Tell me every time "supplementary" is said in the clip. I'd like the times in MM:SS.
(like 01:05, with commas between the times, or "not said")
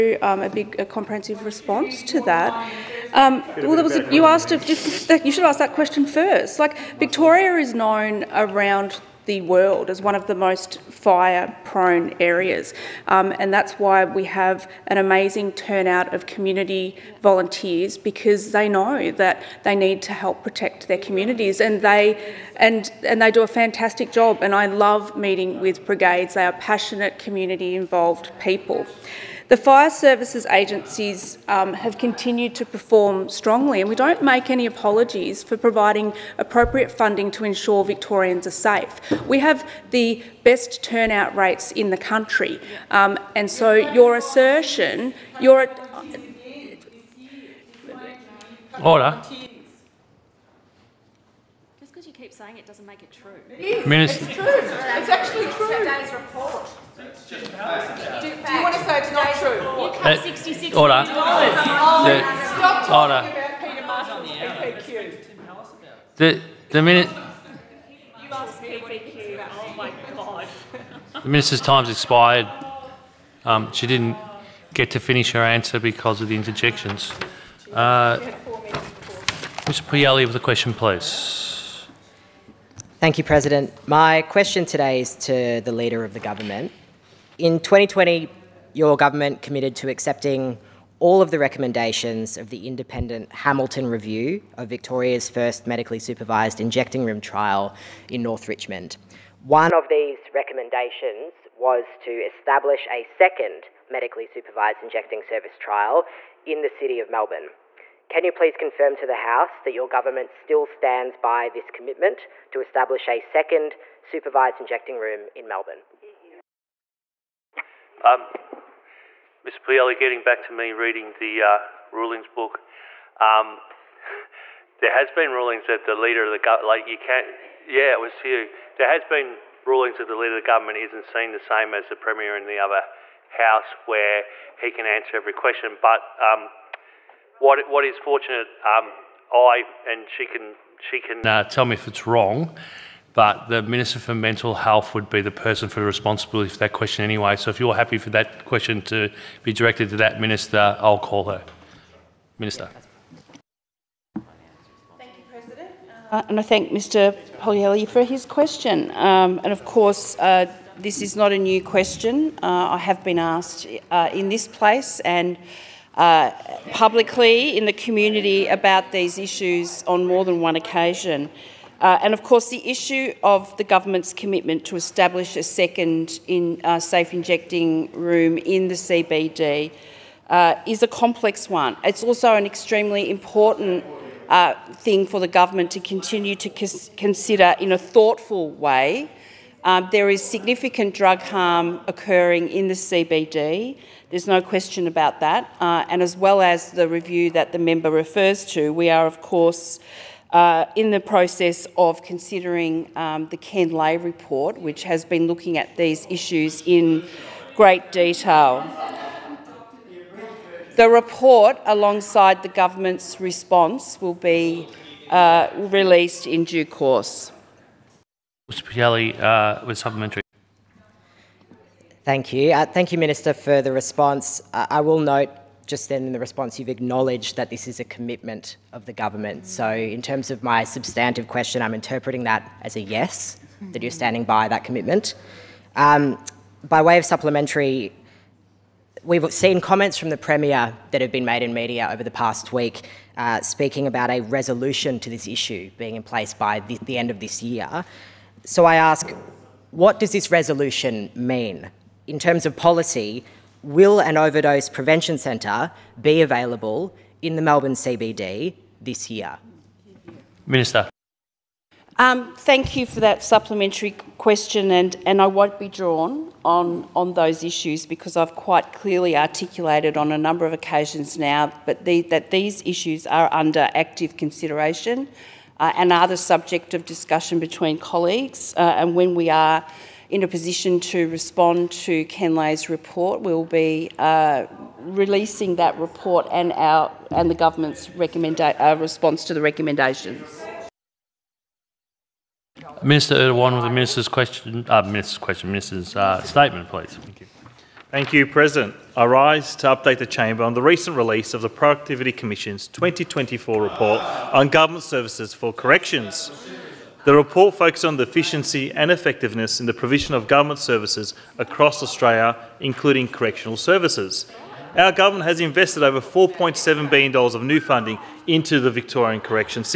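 03:39, 03:57, 04:23.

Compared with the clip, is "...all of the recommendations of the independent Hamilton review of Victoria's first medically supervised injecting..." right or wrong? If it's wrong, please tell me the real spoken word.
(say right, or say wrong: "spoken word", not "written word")
right.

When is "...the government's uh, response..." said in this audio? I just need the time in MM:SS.
04:47.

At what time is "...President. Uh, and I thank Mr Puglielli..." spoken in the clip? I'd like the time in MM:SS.
02:35.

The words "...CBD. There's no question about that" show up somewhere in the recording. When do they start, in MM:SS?
03:12.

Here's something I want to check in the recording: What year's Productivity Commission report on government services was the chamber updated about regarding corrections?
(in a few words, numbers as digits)
2024.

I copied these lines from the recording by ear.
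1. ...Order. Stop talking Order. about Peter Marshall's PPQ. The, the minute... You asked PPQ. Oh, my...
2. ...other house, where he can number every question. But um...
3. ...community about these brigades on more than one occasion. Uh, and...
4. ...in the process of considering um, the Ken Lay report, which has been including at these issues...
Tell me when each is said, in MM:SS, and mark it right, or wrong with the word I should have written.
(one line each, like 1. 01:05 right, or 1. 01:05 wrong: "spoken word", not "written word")
1. 01:00 right
2. 02:12 wrong: "answer", not "number"
3. 02:47 wrong: "issues", not "brigades"
4. 03:20 wrong: "looking", not "including".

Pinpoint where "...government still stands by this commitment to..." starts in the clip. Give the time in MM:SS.
01:49.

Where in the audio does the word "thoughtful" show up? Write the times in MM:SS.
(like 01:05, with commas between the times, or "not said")
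03:07.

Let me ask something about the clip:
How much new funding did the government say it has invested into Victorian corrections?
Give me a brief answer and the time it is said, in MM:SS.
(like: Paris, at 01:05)
$4.7 billion, at 05:16.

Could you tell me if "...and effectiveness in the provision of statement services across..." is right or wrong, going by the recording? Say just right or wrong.
wrong.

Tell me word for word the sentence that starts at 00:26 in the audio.
They are passionate community involved people.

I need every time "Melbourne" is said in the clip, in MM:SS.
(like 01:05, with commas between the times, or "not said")
01:47, 01:55, 04:17.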